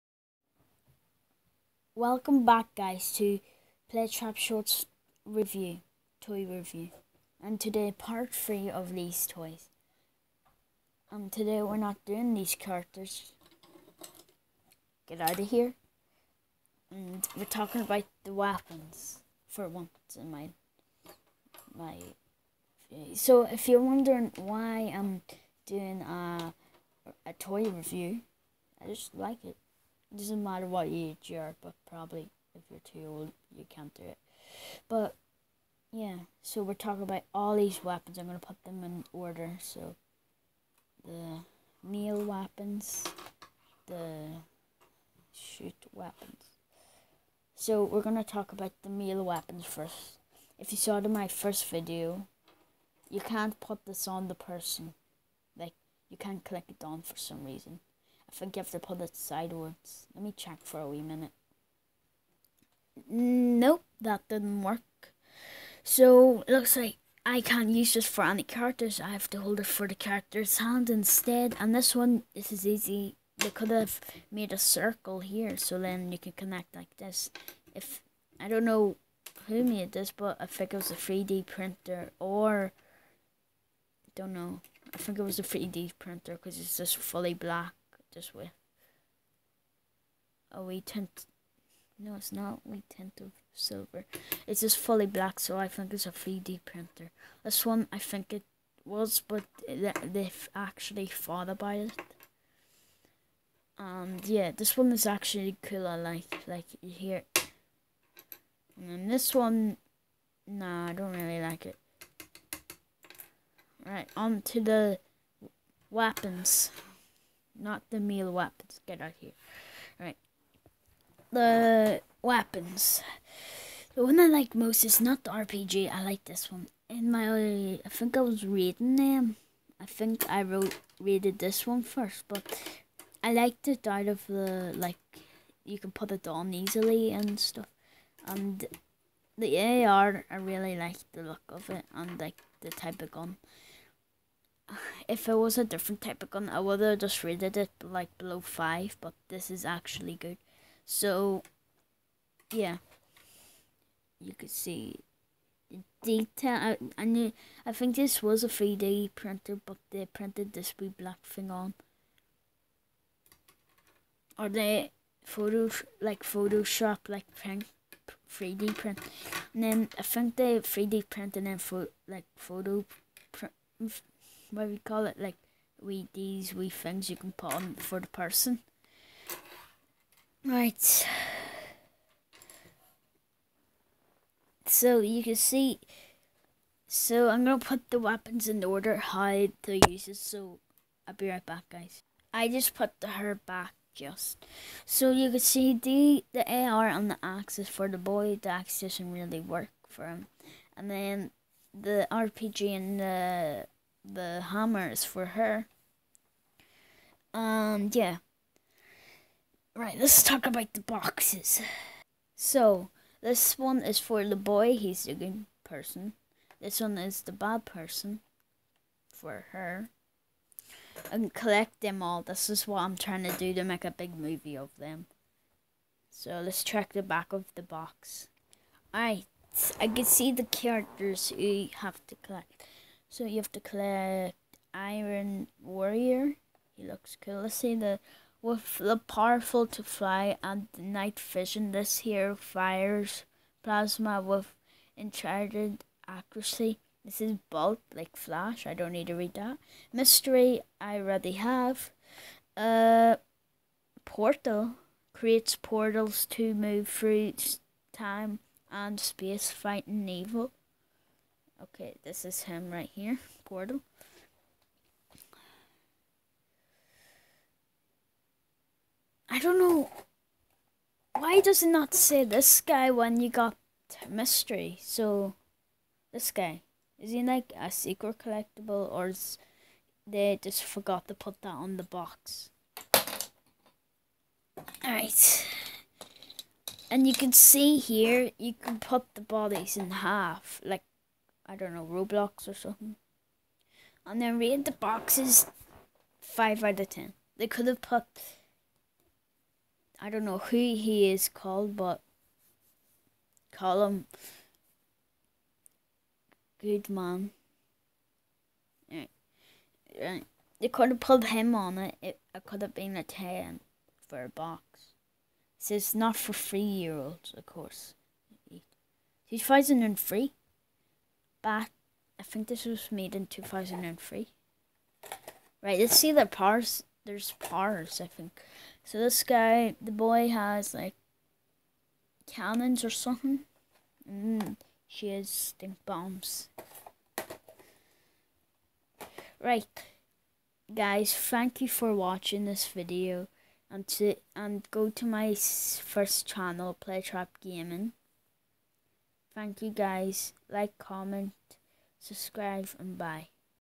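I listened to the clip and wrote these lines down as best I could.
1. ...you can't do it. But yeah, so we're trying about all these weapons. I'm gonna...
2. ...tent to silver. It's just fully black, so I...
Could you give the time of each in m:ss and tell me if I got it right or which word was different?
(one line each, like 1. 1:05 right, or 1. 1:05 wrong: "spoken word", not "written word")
1. 0:33 wrong: "talking", not "trying"
2. 1:32 right.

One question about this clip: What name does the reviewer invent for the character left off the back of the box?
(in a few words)
Good man.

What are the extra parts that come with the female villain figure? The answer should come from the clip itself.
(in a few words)
Stink bombs.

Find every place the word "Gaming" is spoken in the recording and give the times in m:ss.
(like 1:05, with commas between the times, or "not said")
5:47.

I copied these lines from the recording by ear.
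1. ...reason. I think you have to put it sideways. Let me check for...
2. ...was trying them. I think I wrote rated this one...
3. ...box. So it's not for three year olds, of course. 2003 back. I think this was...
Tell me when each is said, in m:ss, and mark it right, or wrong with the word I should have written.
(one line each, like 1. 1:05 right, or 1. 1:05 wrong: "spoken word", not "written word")
1. 0:57 right
2. 2:08 wrong: "reading", not "trying"
3. 5:14 right.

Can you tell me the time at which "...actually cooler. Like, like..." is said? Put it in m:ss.
1:45.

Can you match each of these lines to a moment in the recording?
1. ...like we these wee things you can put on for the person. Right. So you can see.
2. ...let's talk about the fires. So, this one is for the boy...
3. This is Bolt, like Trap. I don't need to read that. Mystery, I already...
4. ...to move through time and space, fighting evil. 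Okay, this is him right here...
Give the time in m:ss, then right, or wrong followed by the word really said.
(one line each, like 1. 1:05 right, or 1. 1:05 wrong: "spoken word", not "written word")
1. 2:55 right
2. 3:29 wrong: "boxes", not "fires"
3. 4:07 wrong: "Flash", not "Trap"
4. 4:16 right.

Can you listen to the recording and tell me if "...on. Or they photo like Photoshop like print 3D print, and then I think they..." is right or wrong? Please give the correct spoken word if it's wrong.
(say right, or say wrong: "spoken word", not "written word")
right.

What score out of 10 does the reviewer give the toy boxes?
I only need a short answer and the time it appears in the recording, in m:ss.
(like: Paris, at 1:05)
5, at 4:56.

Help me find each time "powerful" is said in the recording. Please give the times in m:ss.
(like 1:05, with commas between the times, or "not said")
3:58.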